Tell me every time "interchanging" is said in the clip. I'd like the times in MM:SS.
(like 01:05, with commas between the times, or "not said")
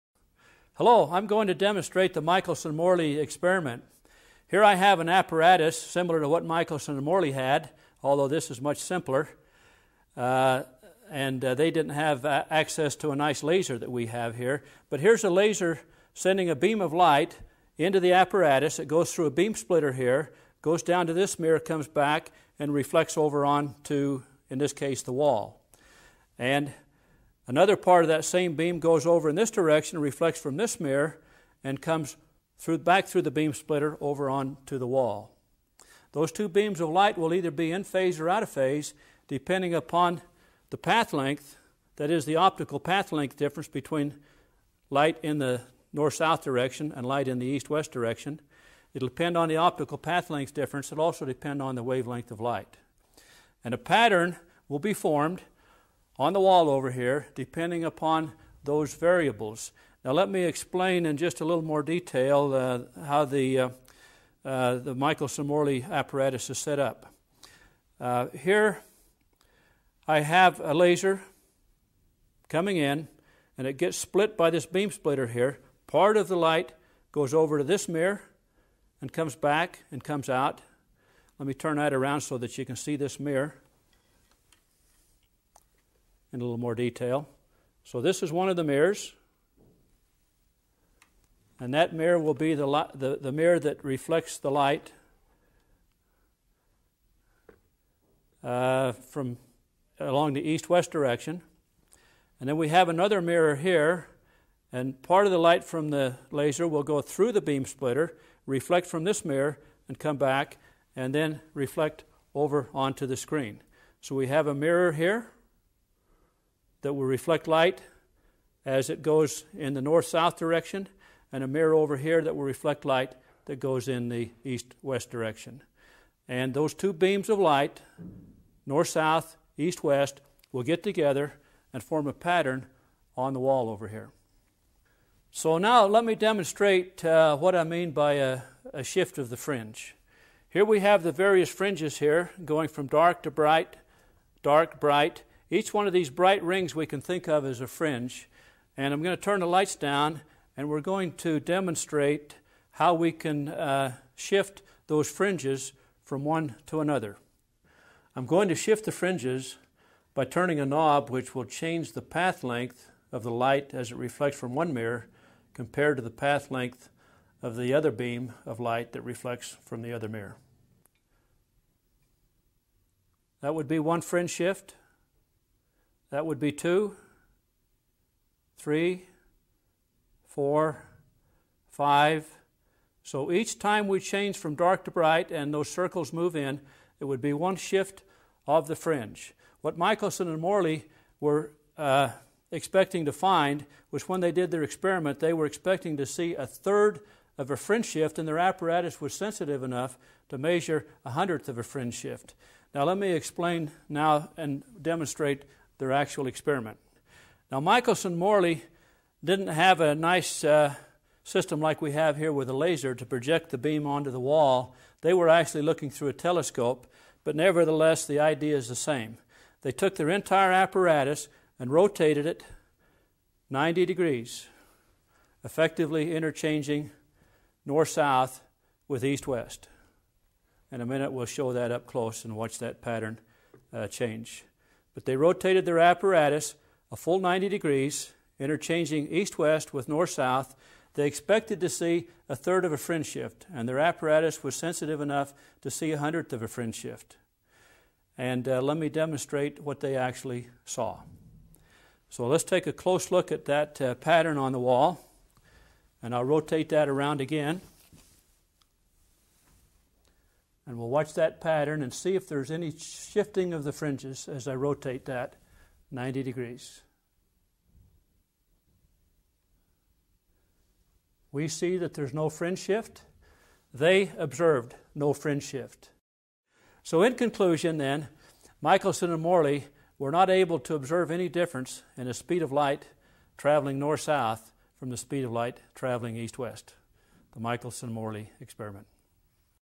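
03:46, 03:58.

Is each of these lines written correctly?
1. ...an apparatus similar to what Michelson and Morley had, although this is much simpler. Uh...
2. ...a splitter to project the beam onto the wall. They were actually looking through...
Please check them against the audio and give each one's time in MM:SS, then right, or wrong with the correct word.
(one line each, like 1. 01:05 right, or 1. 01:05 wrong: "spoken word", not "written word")
1. 00:05 right
2. 03:32 wrong: "laser", not "splitter".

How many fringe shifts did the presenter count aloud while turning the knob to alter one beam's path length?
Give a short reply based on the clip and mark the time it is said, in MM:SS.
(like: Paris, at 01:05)
5, at 03:01.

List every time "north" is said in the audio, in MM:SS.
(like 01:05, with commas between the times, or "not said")
00:45, 01:59, 02:08, 03:47, 03:59, 04:43.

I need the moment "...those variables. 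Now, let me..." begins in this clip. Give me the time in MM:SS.
00:58.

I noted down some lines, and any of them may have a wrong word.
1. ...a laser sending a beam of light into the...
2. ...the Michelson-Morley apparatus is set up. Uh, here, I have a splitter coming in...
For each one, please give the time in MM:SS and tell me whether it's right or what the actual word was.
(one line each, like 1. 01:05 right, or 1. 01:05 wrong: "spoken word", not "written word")
1. 00:15 right
2. 01:04 wrong: "laser", not "splitter".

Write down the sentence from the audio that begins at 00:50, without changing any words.
It'll also depend on the wavelength of light.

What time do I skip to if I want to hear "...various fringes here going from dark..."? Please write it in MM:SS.
02:21.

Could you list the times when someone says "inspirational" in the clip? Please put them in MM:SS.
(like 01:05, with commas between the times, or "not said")
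not said.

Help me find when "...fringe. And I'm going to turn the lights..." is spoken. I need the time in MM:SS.
02:27.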